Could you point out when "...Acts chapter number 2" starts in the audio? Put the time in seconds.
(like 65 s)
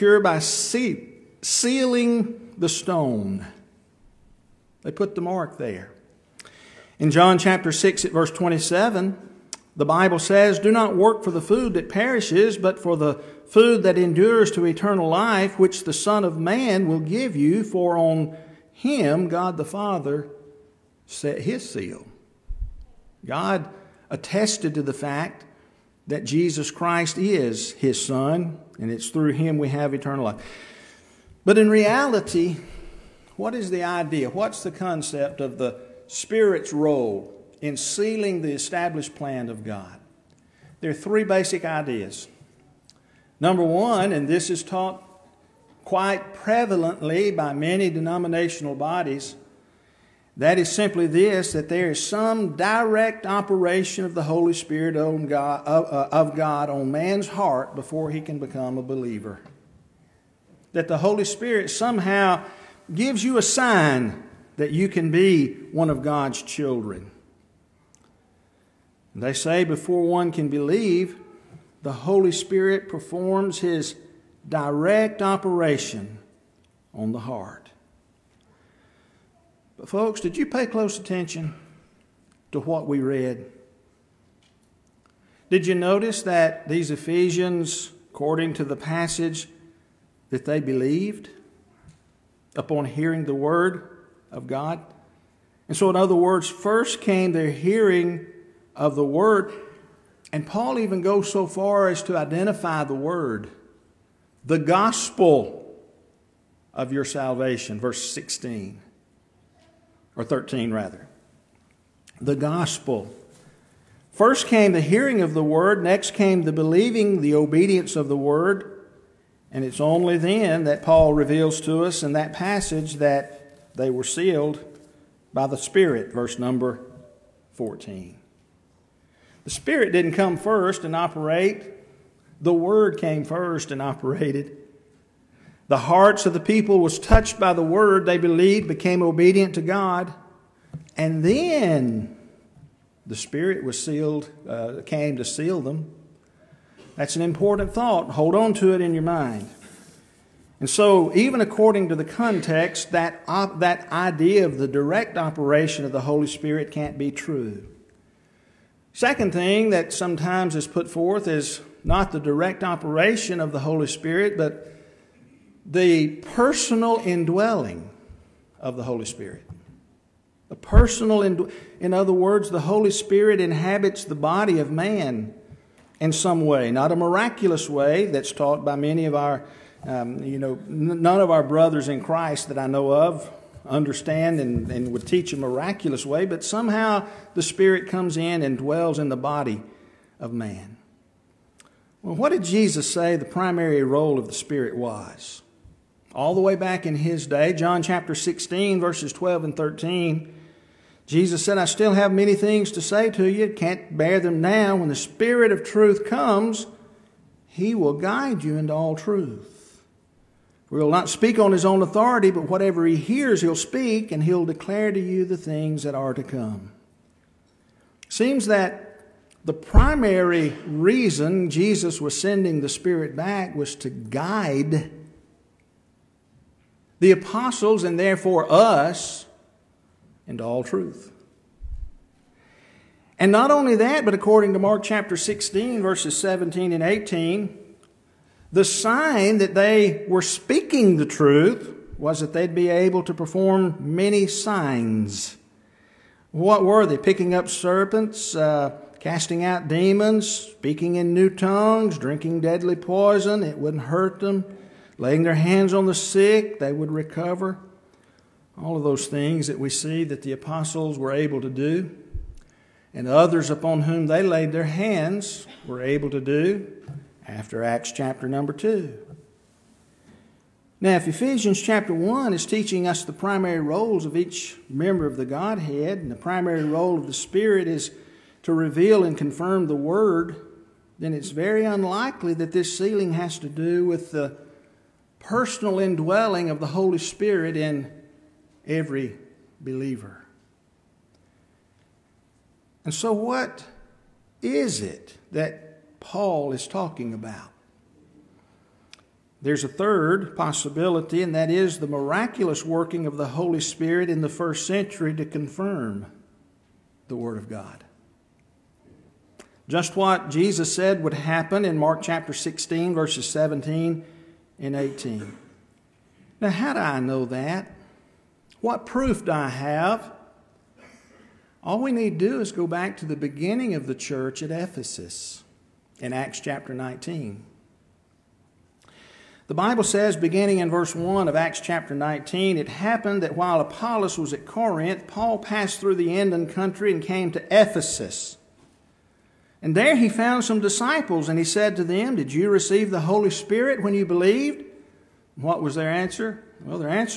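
267 s.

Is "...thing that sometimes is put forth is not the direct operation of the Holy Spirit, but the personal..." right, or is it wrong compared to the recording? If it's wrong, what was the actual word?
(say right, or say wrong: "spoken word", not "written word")
right.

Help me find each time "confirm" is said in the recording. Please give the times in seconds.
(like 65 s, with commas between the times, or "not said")
279 s, 305 s.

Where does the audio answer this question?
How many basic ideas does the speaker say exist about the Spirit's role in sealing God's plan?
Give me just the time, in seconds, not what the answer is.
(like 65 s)
40 s.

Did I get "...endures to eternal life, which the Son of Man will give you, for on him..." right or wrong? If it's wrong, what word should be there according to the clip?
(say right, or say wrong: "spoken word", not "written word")
right.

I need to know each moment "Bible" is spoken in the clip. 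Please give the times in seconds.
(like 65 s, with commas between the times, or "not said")
9 s, 329 s.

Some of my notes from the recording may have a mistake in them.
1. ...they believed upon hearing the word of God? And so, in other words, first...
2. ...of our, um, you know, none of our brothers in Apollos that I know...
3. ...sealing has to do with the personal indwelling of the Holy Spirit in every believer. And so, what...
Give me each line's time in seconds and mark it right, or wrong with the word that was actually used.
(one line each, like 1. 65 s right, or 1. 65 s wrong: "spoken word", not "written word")
1. 90 s right
2. 179 s wrong: "Christ", not "Apollos"
3. 282 s right.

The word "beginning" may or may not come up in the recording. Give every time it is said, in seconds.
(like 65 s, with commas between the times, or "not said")
323 s, 330 s.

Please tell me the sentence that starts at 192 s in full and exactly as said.
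Well, what did Jesus say the primary role of the Spirit was?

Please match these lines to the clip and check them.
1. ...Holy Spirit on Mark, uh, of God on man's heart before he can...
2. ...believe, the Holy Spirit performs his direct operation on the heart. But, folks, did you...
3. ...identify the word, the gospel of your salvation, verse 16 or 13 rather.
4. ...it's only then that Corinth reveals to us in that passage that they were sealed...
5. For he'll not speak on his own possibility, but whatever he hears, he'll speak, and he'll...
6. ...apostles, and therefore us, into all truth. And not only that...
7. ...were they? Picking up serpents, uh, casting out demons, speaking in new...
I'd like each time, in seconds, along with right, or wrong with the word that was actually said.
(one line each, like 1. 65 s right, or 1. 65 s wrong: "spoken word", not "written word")
1. 54 s wrong: "God", not "Mark"
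2. 70 s right
3. 102 s right
4. 119 s wrong: "Paul", not "Corinth"
5. 210 s wrong: "authority", not "possibility"
6. 227 s right
7. 246 s right.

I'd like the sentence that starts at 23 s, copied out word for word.
God attested to the fact that Jesus Christ is his son, and it's through him we have eternal life.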